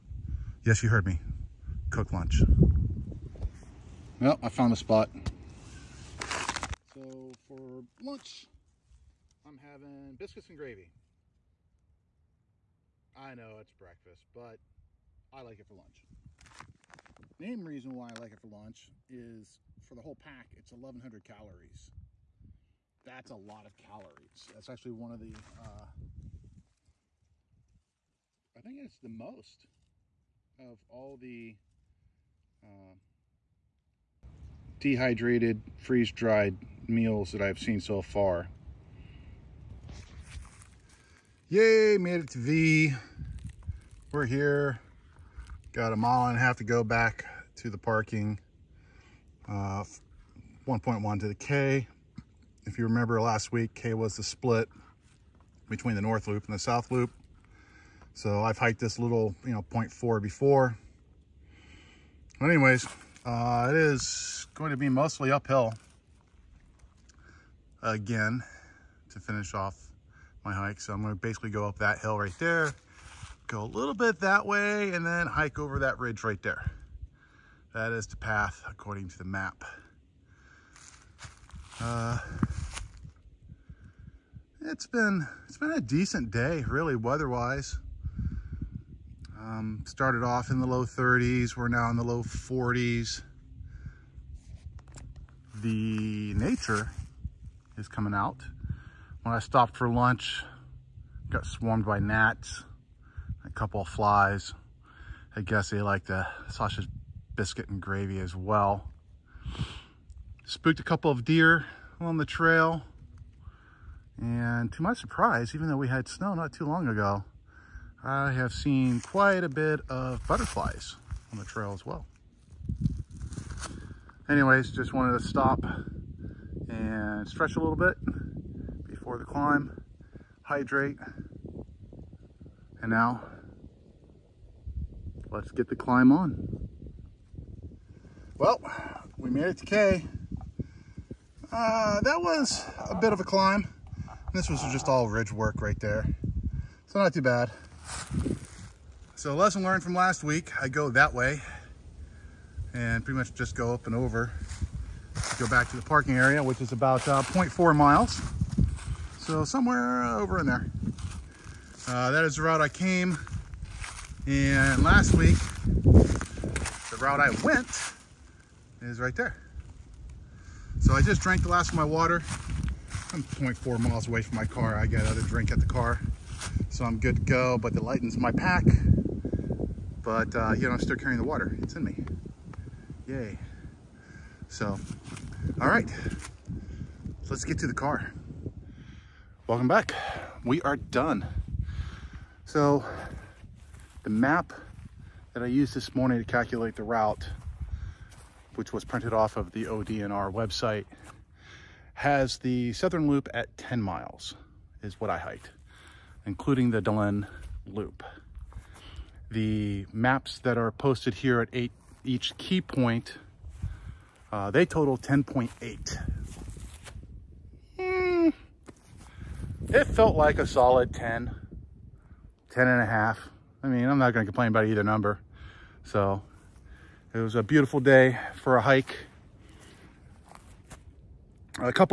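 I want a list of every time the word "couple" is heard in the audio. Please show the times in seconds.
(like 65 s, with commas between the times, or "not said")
103 s, 110 s.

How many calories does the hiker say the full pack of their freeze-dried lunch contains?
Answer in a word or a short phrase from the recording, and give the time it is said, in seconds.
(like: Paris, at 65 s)
1,100, at 20 s.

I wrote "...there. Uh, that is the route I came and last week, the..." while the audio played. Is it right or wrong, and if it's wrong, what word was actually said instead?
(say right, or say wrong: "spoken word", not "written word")
right.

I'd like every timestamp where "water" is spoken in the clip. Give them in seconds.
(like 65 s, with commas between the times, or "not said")
171 s, 181 s.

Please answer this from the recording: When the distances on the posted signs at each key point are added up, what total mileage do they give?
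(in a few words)
10.8 miles.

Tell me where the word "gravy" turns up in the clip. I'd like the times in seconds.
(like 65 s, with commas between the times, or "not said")
10 s, 107 s.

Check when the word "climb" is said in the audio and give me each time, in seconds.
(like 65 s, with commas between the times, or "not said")
129 s, 135 s, 143 s.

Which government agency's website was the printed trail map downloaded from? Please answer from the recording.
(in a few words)
ODNR.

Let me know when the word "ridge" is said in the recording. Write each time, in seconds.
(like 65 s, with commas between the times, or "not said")
75 s, 145 s.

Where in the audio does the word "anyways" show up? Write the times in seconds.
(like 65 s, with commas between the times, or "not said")
62 s, 124 s.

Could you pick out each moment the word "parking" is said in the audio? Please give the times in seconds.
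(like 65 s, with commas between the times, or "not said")
47 s, 155 s.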